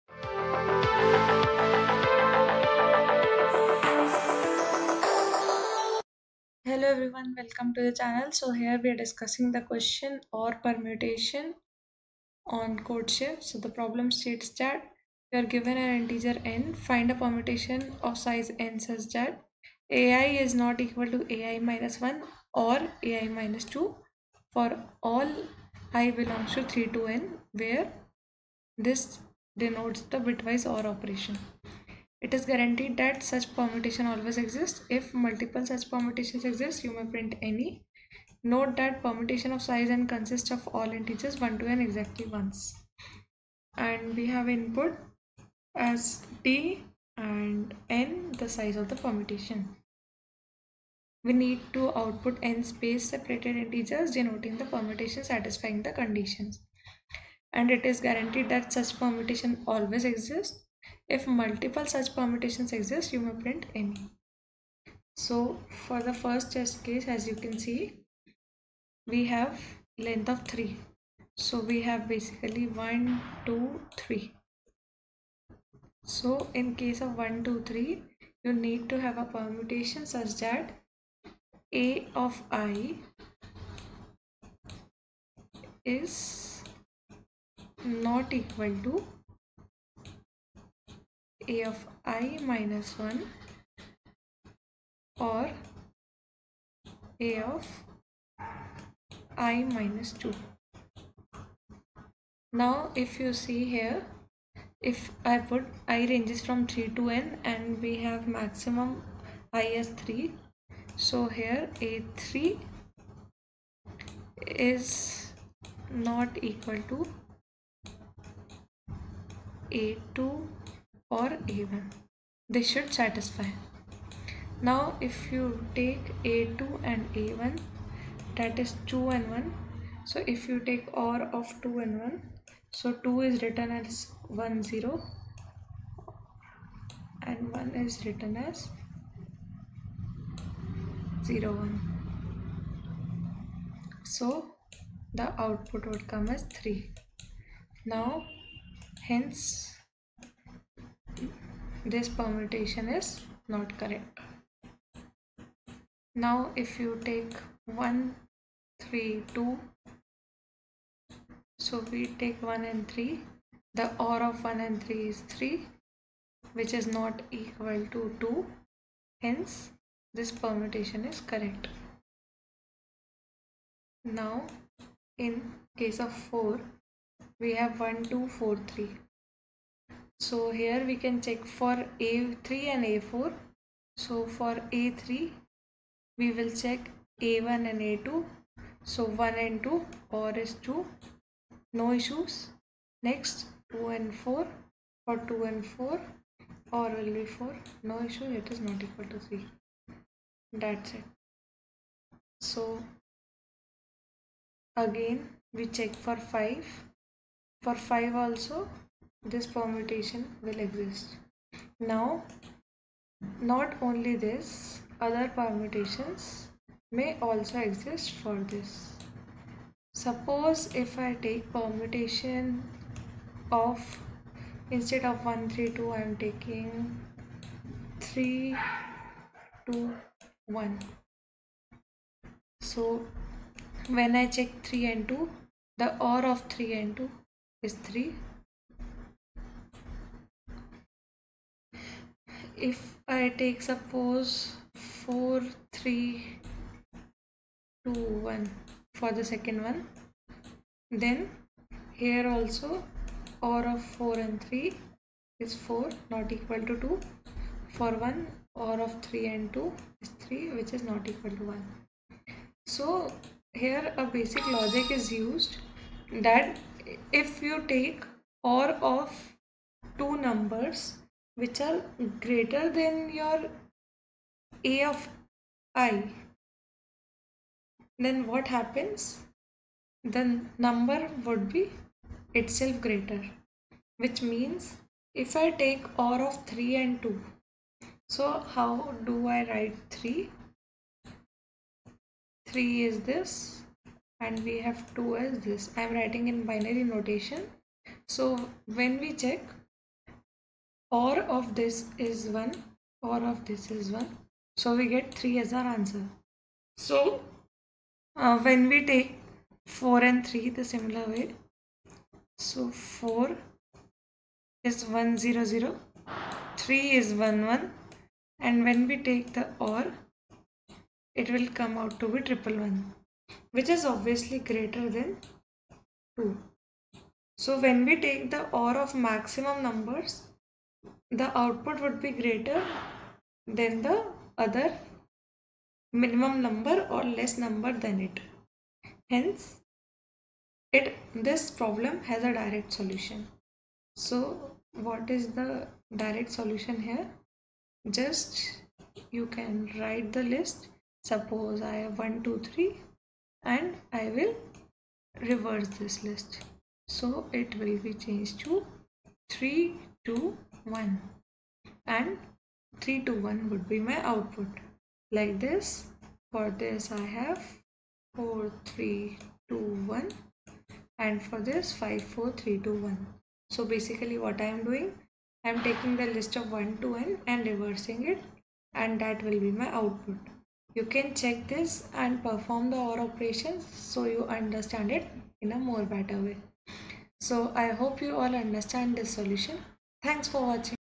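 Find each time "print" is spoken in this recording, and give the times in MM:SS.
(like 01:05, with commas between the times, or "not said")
00:37, 01:03.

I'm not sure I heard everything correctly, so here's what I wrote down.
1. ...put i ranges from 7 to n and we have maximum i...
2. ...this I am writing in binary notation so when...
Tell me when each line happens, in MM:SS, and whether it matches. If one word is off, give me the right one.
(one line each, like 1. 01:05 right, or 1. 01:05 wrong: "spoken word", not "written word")
1. 01:45 wrong: "3", not "7"
2. 04:55 right.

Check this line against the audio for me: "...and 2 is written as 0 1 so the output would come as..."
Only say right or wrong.
wrong.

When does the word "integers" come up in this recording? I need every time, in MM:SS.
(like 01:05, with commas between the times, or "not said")
00:15, 00:40, 00:53.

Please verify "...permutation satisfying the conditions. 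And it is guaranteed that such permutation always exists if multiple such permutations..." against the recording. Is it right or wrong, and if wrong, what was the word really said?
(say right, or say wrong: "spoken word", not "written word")
right.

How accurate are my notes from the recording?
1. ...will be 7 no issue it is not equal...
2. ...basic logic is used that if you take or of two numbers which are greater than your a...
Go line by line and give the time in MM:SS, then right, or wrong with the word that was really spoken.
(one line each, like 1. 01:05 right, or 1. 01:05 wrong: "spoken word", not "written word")
1. 03:16 wrong: "4", not "7"
2. 04:24 right.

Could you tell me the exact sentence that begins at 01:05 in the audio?
So for the first test case, as you can see, we have length of 3.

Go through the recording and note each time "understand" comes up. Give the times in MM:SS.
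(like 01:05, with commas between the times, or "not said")
06:24, 06:28.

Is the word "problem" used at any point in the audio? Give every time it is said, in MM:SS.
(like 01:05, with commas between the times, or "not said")
00:13, 05:41.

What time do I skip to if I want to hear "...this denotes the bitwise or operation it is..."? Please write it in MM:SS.
00:28.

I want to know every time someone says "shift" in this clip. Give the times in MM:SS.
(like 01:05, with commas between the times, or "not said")
00:13.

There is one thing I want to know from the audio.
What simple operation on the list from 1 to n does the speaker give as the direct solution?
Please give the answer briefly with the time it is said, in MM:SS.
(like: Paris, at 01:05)
reversing it, at 06:17.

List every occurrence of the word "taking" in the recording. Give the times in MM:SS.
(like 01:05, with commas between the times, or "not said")
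03:46, 06:15.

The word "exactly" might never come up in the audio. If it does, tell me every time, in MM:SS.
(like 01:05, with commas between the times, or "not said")
00:41.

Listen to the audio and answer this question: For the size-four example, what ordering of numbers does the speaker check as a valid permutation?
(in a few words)
1, 2, 4, 3.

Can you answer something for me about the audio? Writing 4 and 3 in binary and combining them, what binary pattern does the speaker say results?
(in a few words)
triple one.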